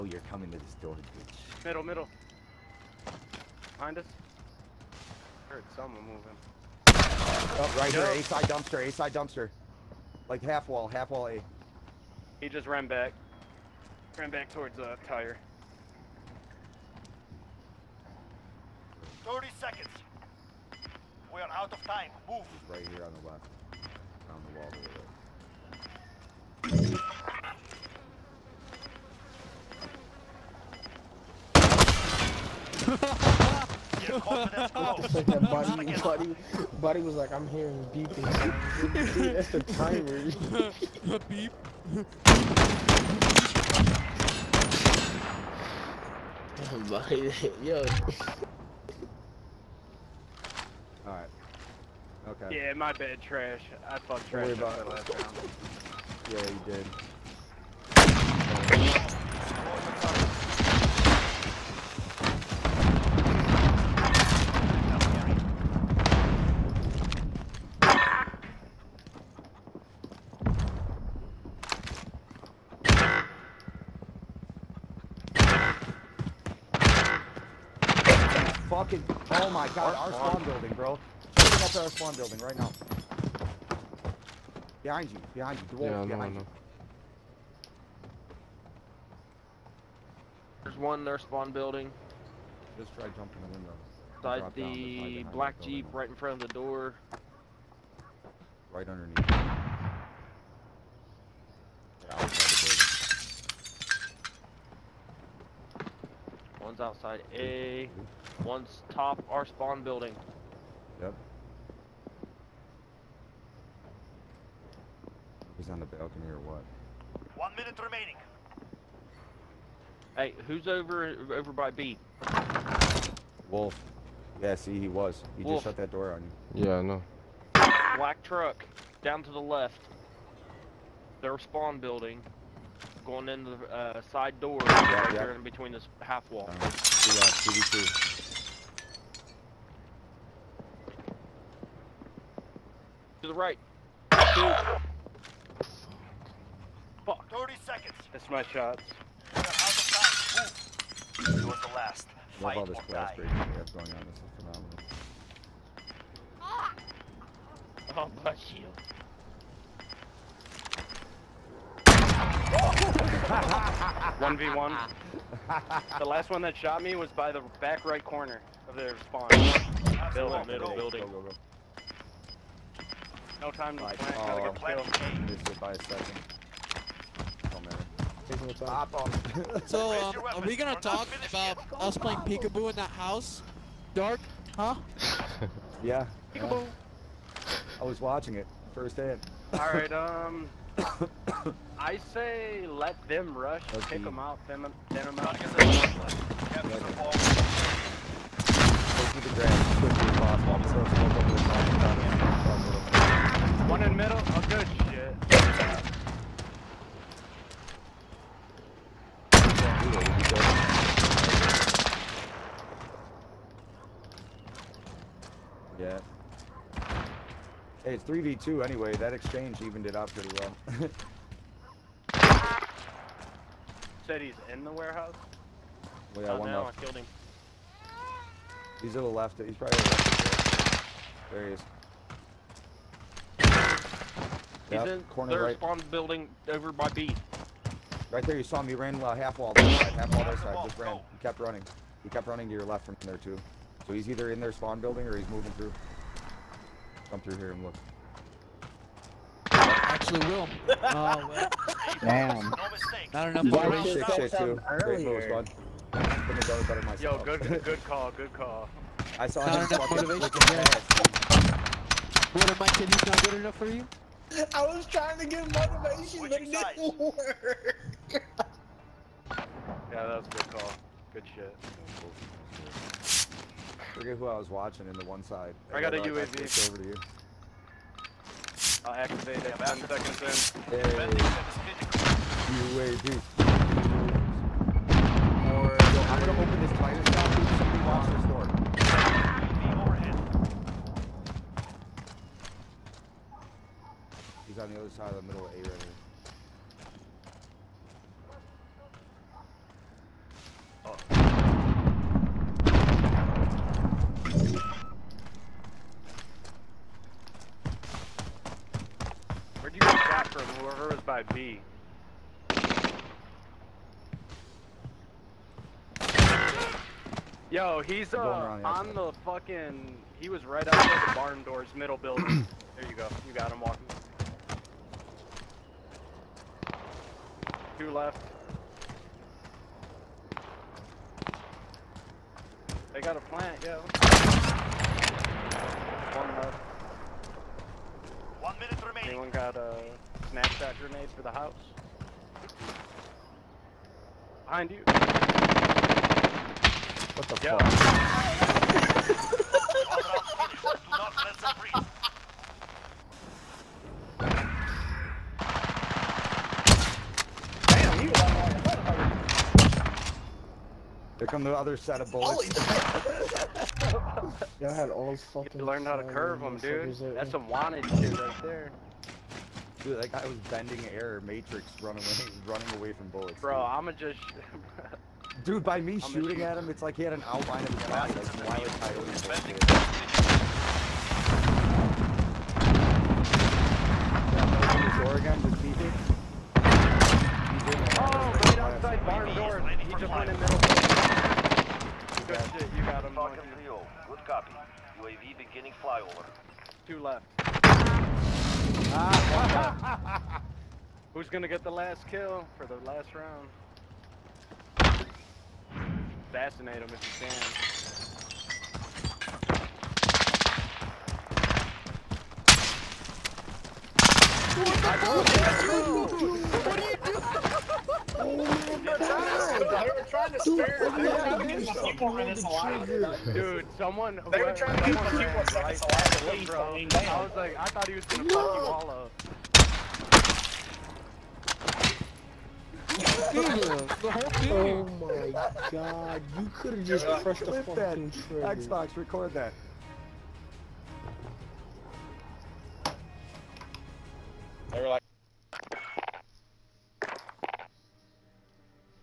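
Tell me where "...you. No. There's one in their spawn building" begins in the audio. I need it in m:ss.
1:26.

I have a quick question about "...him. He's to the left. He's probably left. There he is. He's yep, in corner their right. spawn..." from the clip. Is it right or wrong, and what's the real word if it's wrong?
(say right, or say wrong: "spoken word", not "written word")
right.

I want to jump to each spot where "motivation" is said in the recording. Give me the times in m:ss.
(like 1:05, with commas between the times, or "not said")
4:19, 4:25.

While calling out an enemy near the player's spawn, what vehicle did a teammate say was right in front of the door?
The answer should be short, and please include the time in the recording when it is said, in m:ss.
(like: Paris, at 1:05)
black jeep, at 1:35.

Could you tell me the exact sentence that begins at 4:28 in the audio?
yeah, that was a good call.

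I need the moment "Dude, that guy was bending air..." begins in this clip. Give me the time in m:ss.
6:09.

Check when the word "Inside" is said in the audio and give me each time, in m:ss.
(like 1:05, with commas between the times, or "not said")
1:34.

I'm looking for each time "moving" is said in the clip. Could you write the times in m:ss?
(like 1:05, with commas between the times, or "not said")
0:06, 4:05.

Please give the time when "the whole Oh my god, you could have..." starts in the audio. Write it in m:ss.
7:14.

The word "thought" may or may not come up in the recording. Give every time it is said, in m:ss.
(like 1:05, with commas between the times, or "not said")
0:53, 7:07.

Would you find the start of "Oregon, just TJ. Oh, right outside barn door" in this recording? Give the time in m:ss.
6:25.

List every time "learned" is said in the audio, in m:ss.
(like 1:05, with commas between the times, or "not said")
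6:05.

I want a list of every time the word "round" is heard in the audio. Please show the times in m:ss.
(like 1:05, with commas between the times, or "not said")
0:54, 6:43.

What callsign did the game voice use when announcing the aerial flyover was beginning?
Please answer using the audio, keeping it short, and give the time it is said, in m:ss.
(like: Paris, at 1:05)
Falcon 3, at 6:33.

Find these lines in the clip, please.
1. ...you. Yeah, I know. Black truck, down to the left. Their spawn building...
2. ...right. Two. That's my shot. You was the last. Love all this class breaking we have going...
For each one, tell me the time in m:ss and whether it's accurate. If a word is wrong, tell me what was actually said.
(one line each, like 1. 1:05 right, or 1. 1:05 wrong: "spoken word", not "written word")
1. 2:06 right
2. 2:23 right.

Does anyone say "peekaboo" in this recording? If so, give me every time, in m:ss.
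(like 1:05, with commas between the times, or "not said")
3:02, 3:06.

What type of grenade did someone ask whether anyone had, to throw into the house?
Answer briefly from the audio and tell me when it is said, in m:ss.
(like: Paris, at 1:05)
snapshot grenade, at 5:40.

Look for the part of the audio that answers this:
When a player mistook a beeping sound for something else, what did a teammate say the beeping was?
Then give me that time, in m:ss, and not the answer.
0:39.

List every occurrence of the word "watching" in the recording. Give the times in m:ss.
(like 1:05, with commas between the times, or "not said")
3:07, 4:34.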